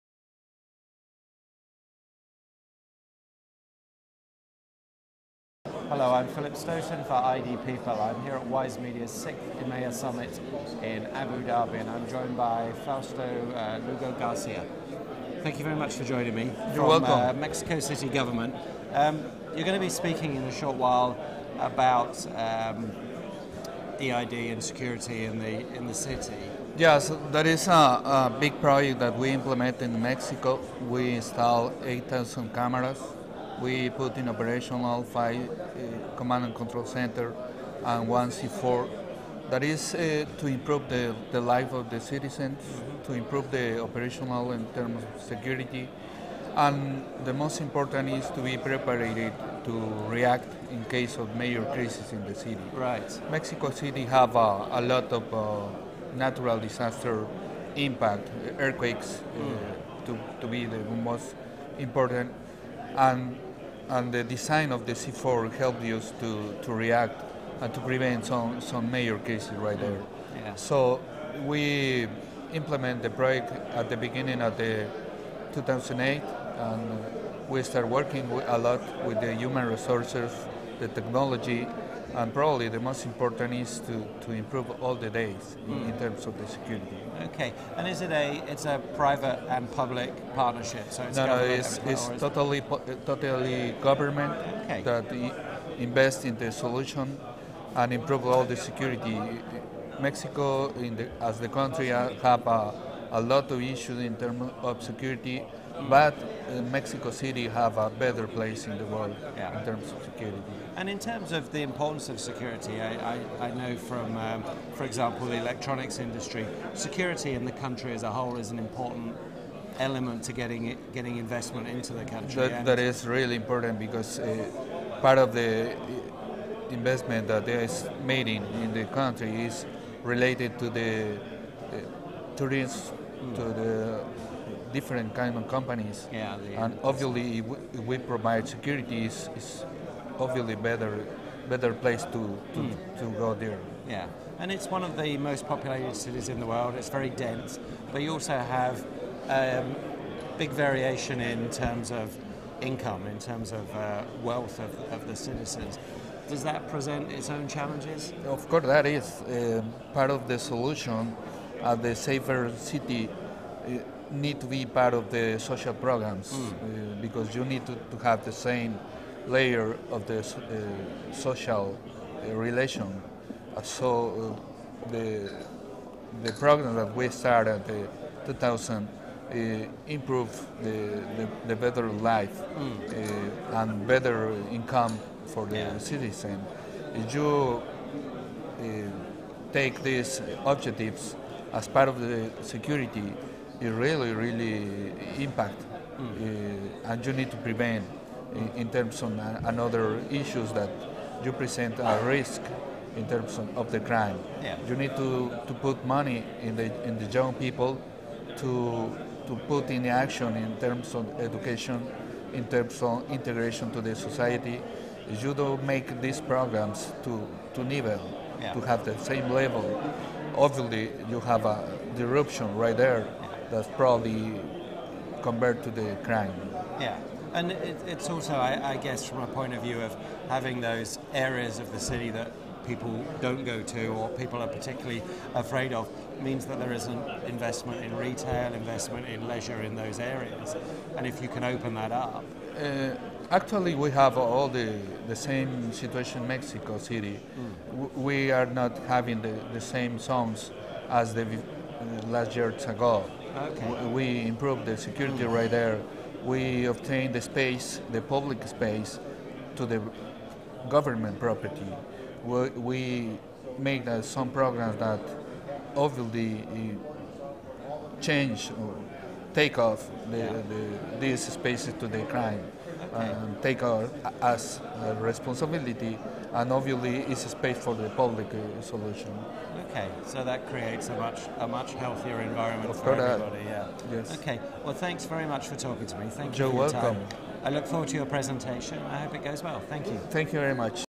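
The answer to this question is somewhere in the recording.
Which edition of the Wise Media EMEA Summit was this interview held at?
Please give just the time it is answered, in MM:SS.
00:09.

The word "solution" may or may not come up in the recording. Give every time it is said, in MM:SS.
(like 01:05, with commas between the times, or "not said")
01:36, 02:40, 04:38.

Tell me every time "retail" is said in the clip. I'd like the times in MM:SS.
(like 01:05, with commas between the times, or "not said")
03:57.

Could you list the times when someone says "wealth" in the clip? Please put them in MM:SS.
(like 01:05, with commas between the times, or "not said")
02:34.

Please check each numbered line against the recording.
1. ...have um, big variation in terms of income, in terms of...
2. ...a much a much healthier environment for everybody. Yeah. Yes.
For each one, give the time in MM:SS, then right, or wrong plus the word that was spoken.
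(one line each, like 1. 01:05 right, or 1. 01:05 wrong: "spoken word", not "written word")
1. 02:28 right
2. 04:40 right.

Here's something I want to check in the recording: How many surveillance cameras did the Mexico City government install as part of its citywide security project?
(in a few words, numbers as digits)
8,000.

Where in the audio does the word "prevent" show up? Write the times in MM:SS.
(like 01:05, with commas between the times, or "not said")
01:07, 03:17.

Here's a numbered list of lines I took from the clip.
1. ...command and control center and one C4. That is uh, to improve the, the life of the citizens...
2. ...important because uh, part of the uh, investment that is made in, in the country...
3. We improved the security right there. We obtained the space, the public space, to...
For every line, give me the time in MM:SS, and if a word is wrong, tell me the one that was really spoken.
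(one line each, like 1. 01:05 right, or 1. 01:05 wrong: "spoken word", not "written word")
1. 00:36 right
2. 02:03 right
3. 04:13 right.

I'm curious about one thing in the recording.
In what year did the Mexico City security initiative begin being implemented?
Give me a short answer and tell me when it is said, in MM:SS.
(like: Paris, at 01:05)
2008, at 01:15.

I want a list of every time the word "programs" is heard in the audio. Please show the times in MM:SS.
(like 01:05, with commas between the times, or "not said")
02:45, 02:56, 03:36, 04:24.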